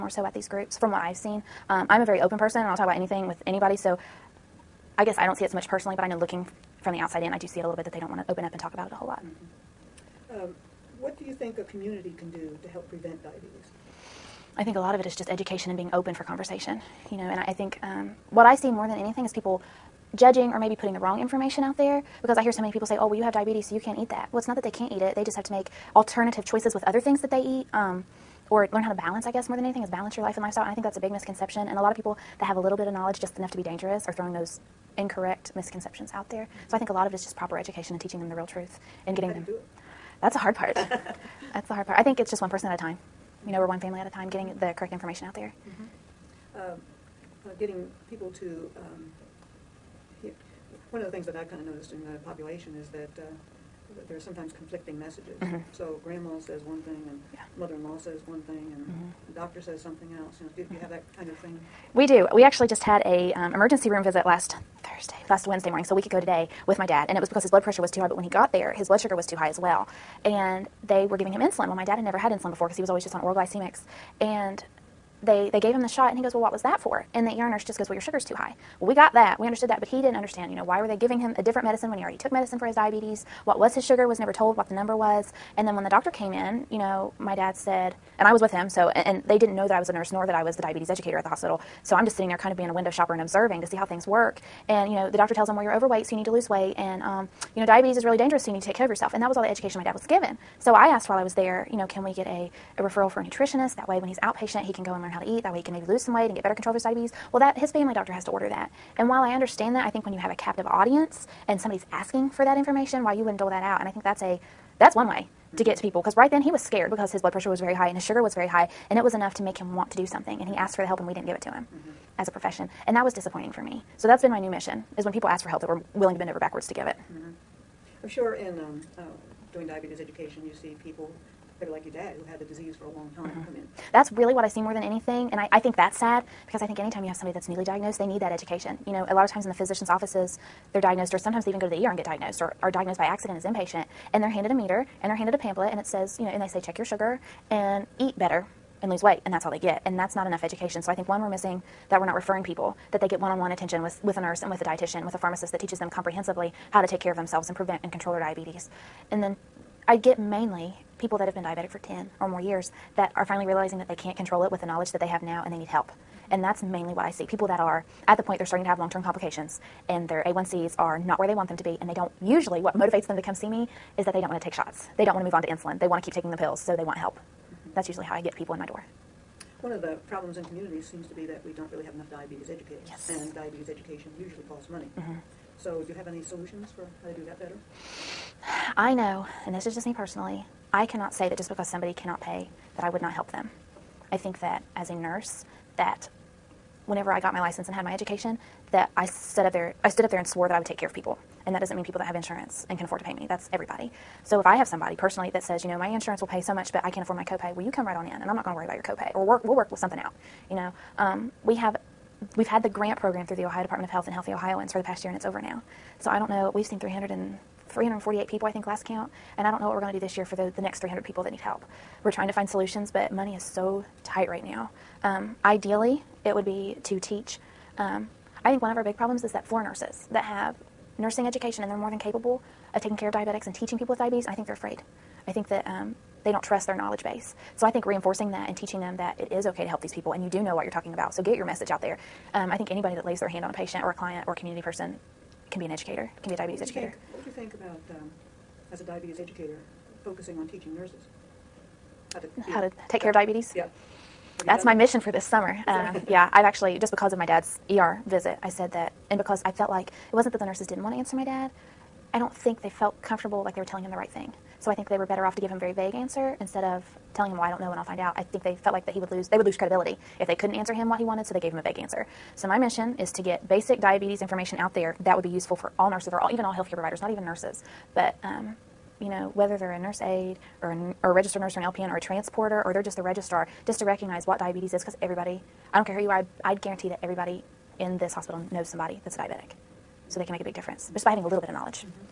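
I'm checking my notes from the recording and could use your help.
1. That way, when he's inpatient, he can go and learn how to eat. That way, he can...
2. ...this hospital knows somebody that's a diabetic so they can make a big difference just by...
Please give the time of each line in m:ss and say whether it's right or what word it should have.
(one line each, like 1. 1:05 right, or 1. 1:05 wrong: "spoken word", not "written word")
1. 1:43 wrong: "outpatient", not "inpatient"
2. 4:47 right.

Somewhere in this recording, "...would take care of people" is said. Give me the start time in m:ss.
3:20.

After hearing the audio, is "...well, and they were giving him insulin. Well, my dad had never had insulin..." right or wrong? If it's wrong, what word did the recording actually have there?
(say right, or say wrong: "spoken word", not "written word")
right.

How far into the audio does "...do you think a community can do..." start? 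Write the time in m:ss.
0:11.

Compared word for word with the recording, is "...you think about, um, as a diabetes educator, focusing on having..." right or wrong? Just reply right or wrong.
wrong.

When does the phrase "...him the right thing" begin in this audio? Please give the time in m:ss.
4:23.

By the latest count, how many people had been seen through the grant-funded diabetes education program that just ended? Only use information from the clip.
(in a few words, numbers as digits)
348.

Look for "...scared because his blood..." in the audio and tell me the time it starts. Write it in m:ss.
1:56.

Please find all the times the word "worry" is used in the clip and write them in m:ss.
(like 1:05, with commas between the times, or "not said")
3:28.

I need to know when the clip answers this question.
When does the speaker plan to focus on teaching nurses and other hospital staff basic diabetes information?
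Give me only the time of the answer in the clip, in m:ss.
4:15.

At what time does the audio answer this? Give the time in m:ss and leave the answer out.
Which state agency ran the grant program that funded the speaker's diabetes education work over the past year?
3:33.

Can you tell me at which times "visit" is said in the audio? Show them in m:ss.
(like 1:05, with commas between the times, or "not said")
1:04, 4:18.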